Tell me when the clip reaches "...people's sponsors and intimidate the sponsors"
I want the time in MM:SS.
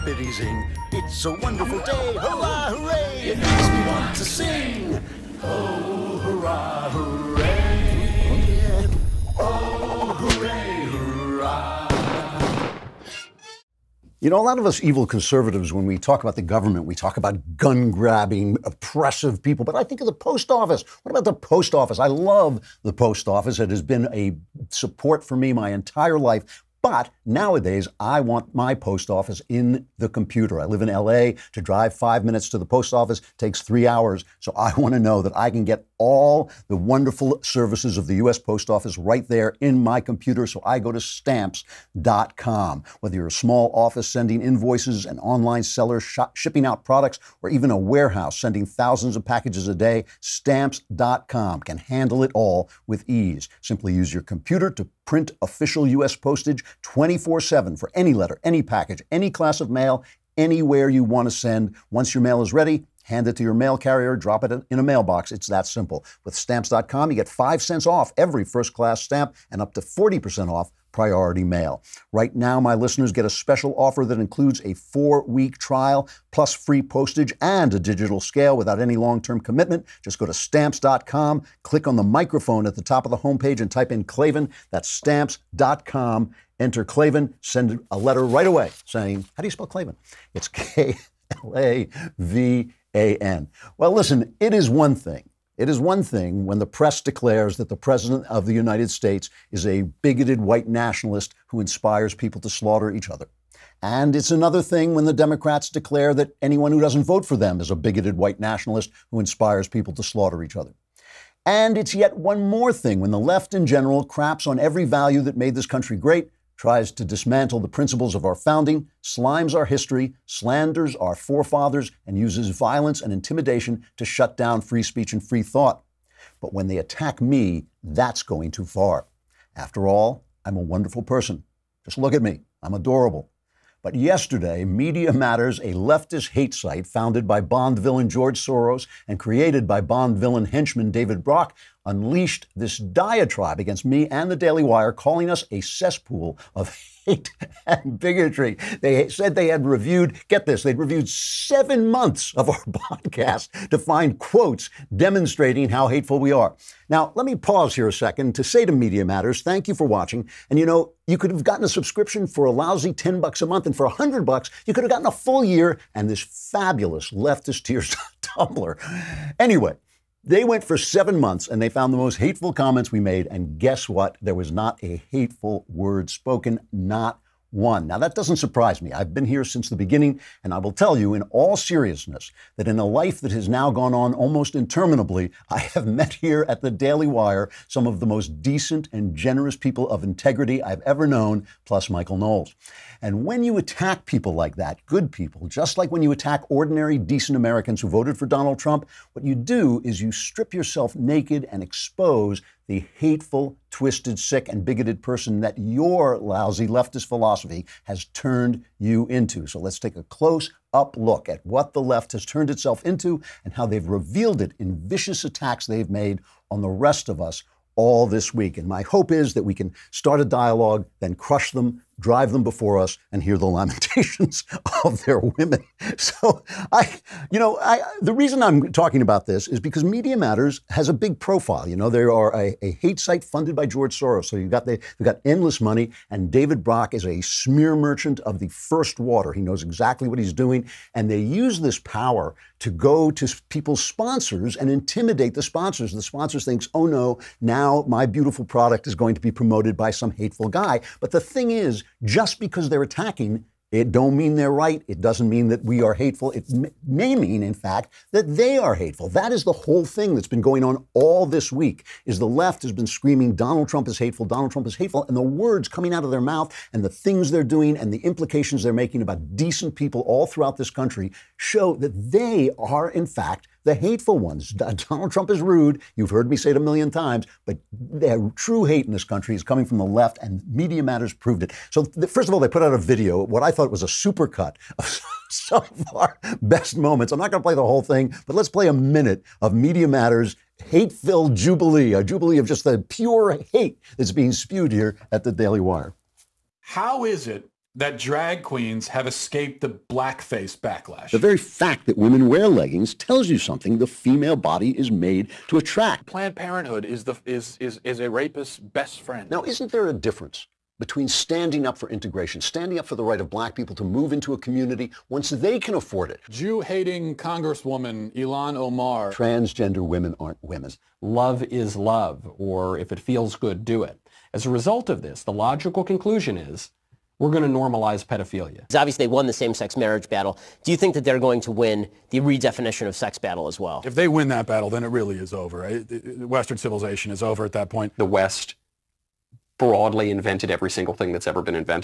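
04:03.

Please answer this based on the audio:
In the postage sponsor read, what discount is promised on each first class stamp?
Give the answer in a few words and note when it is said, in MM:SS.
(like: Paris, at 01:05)
5 cents, at 01:07.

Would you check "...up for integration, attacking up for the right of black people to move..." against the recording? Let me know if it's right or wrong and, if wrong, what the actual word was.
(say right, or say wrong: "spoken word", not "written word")
wrong: "standing", not "attacking".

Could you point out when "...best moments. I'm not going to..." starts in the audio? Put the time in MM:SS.
04:46.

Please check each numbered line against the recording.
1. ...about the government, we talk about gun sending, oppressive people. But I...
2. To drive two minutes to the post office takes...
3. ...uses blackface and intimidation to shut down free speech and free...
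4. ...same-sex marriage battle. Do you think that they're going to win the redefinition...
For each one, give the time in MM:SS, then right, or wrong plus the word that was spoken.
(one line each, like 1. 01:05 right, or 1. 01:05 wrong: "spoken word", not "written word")
1. 00:16 wrong: "grabbing", not "sending"
2. 00:31 wrong: "five", not "two"
3. 02:02 wrong: "violence", not "blackface"
4. 05:29 right.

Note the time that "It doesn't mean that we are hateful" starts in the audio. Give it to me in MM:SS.
04:14.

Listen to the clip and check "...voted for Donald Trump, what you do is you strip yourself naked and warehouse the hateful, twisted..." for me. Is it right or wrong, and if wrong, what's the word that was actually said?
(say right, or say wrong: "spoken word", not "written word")
wrong: "expose", not "warehouse".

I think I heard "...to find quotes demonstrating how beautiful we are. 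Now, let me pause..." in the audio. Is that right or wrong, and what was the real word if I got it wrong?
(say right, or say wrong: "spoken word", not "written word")
wrong: "hateful", not "beautiful".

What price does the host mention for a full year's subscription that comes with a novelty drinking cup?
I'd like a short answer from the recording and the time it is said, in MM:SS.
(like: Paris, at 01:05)
$100, at 02:43.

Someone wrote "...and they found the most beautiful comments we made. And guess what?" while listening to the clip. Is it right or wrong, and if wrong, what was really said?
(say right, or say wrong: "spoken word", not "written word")
wrong: "hateful", not "beautiful".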